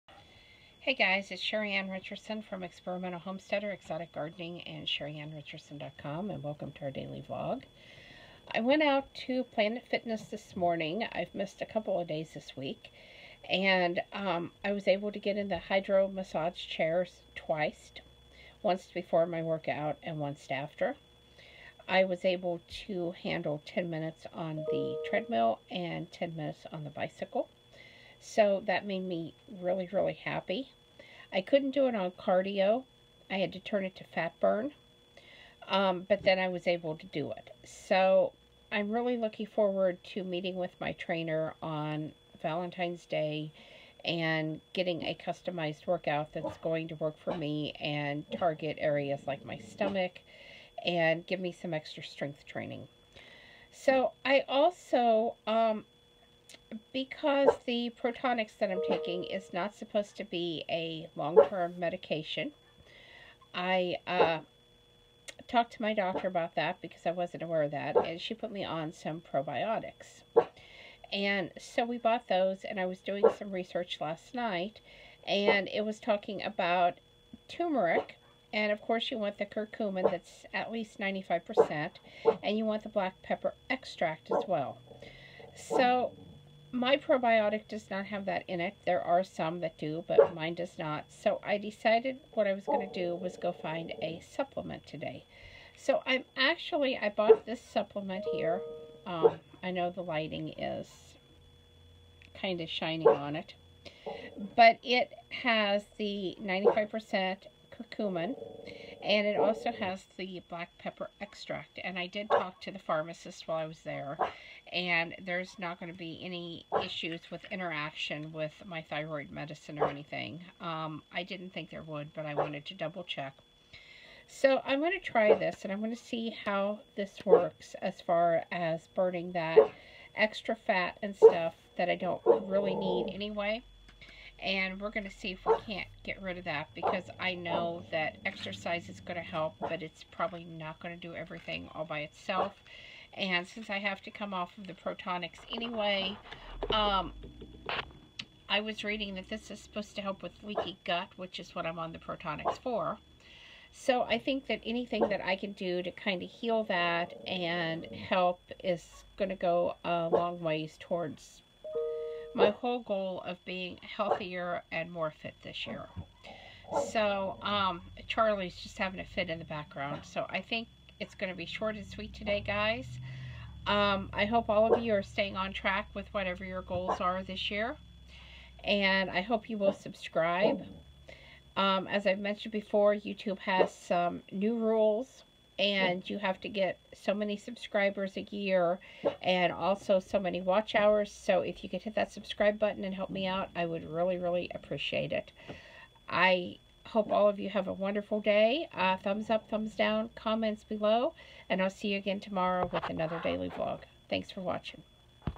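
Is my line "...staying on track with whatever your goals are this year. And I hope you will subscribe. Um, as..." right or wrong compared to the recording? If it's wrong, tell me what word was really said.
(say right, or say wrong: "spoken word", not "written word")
right.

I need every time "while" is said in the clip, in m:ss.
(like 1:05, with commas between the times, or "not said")
1:53.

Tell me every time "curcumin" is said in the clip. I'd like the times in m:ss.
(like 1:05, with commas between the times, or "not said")
1:19, 1:47.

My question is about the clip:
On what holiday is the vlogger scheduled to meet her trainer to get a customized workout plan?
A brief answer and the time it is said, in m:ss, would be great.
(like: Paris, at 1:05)
Valentine's Day, at 0:42.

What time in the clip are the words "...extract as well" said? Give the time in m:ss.
1:23.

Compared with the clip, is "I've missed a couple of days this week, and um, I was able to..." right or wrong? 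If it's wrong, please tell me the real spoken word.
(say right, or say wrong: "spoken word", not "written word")
right.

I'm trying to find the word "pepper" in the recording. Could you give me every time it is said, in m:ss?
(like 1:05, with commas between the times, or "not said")
1:23, 1:50.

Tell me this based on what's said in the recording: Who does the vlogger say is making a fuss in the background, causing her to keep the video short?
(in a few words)
Charlie.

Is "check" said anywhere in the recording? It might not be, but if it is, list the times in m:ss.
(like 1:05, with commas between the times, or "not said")
2:03.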